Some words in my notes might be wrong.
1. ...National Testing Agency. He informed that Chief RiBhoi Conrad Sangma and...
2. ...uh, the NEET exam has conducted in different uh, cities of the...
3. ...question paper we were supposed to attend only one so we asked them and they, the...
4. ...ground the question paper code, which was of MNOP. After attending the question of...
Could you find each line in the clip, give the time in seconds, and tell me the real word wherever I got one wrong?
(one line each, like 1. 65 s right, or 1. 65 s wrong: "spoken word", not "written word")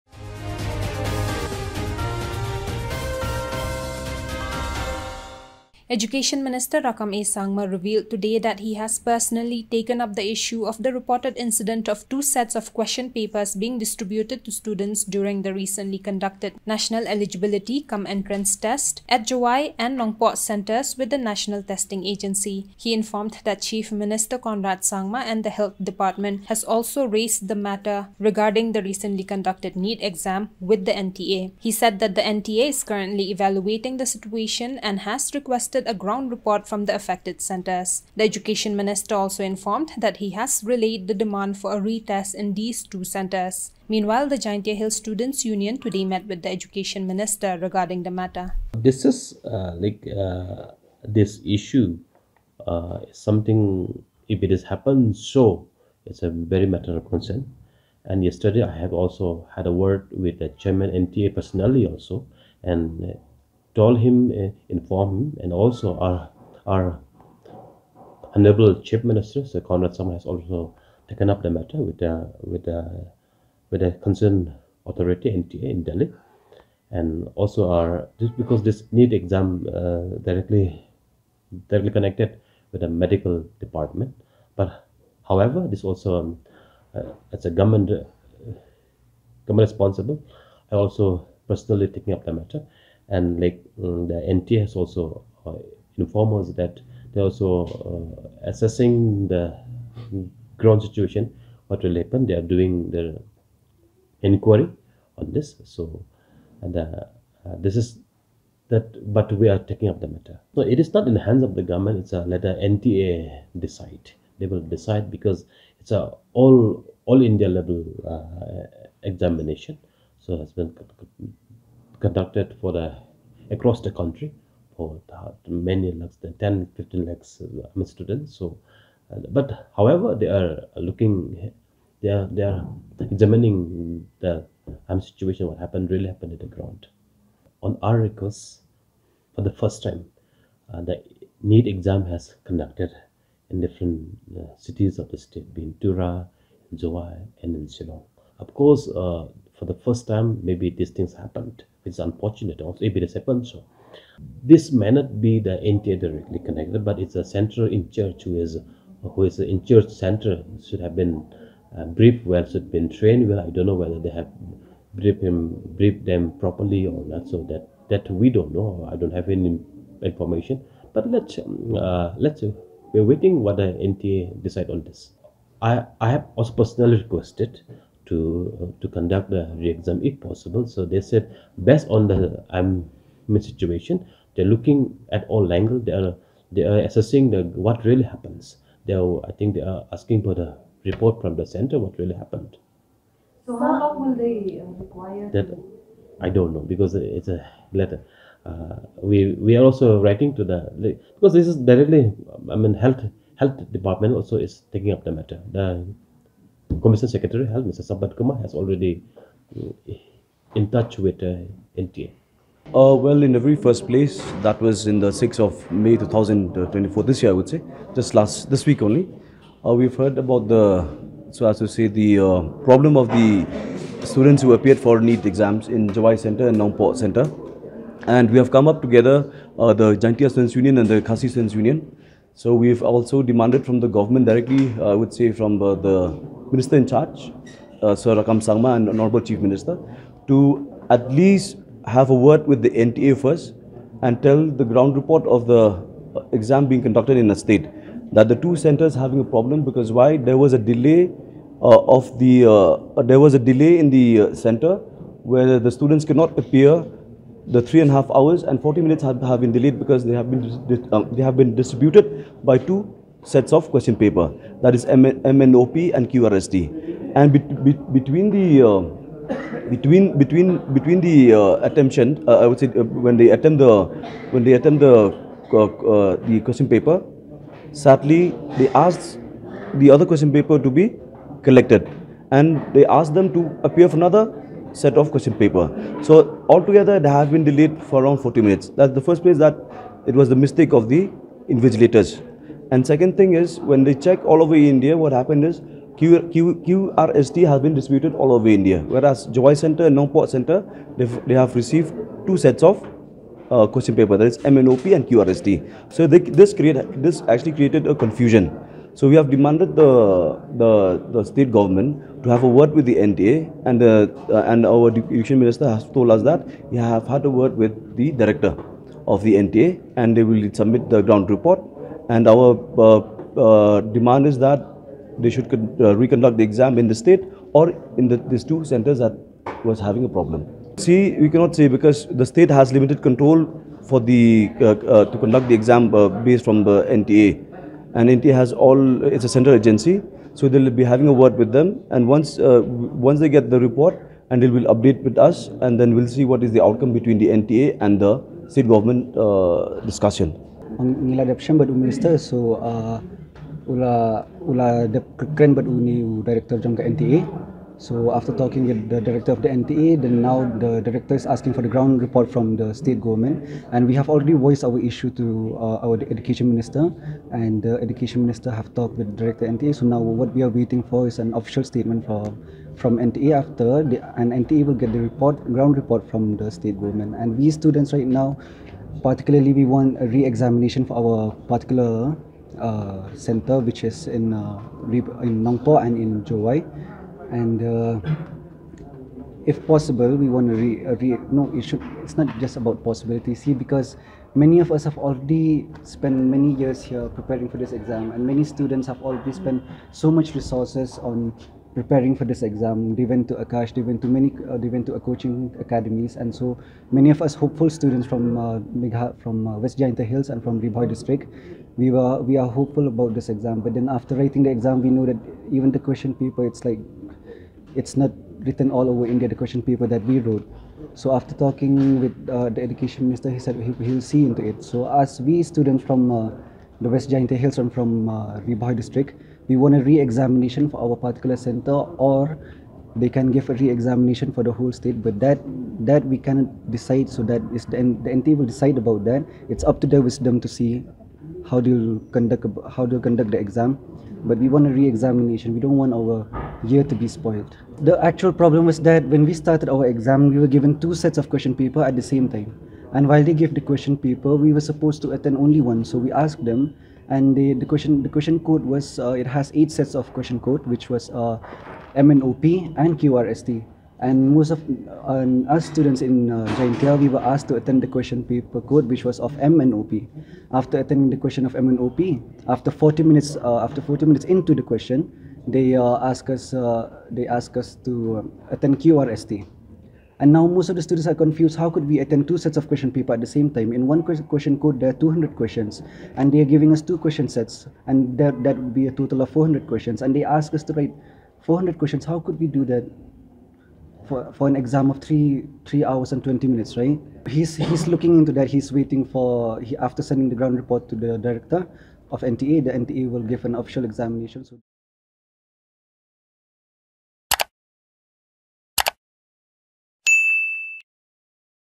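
1. 21 s wrong: "Minister", not "RiBhoi"
2. 140 s right
3. 453 s right
4. 467 s wrong: "attend", not "ground".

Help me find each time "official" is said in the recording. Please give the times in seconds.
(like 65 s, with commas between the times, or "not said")
371 s, 503 s.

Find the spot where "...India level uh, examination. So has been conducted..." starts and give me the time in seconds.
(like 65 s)
117 s.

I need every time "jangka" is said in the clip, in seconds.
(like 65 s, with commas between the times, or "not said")
356 s.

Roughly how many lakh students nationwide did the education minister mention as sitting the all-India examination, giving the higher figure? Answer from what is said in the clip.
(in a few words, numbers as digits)
15 lakhs.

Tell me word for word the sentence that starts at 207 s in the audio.
Sampath Kumar, has already mm, in touch with uh, NTA?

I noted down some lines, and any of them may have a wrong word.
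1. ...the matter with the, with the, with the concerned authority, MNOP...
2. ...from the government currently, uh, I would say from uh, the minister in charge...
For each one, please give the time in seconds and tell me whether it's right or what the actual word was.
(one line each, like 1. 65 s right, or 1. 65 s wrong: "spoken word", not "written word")
1. 71 s wrong: "NTA", not "MNOP"
2. 233 s wrong: "directly", not "currently".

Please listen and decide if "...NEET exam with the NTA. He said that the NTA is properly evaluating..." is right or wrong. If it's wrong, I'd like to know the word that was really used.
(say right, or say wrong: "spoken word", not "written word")
wrong: "currently", not "properly".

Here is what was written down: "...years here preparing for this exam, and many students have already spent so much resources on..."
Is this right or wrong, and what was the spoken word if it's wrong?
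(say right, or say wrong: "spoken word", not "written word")
right.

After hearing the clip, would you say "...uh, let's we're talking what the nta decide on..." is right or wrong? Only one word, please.
wrong.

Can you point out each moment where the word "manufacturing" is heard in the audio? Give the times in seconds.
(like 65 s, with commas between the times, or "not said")
not said.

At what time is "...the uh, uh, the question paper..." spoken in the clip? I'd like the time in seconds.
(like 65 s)
274 s.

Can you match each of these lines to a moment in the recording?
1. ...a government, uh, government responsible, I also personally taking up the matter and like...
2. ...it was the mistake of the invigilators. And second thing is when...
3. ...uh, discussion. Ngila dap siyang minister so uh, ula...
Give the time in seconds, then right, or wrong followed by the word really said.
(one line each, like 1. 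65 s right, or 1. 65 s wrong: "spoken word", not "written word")
1. 87 s right
2. 290 s right
3. 349 s right.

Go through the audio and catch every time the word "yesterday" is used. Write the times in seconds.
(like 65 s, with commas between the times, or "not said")
58 s.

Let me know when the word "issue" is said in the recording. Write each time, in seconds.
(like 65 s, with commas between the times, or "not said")
10 s, 51 s, 364 s.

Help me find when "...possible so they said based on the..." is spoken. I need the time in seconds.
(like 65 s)
180 s.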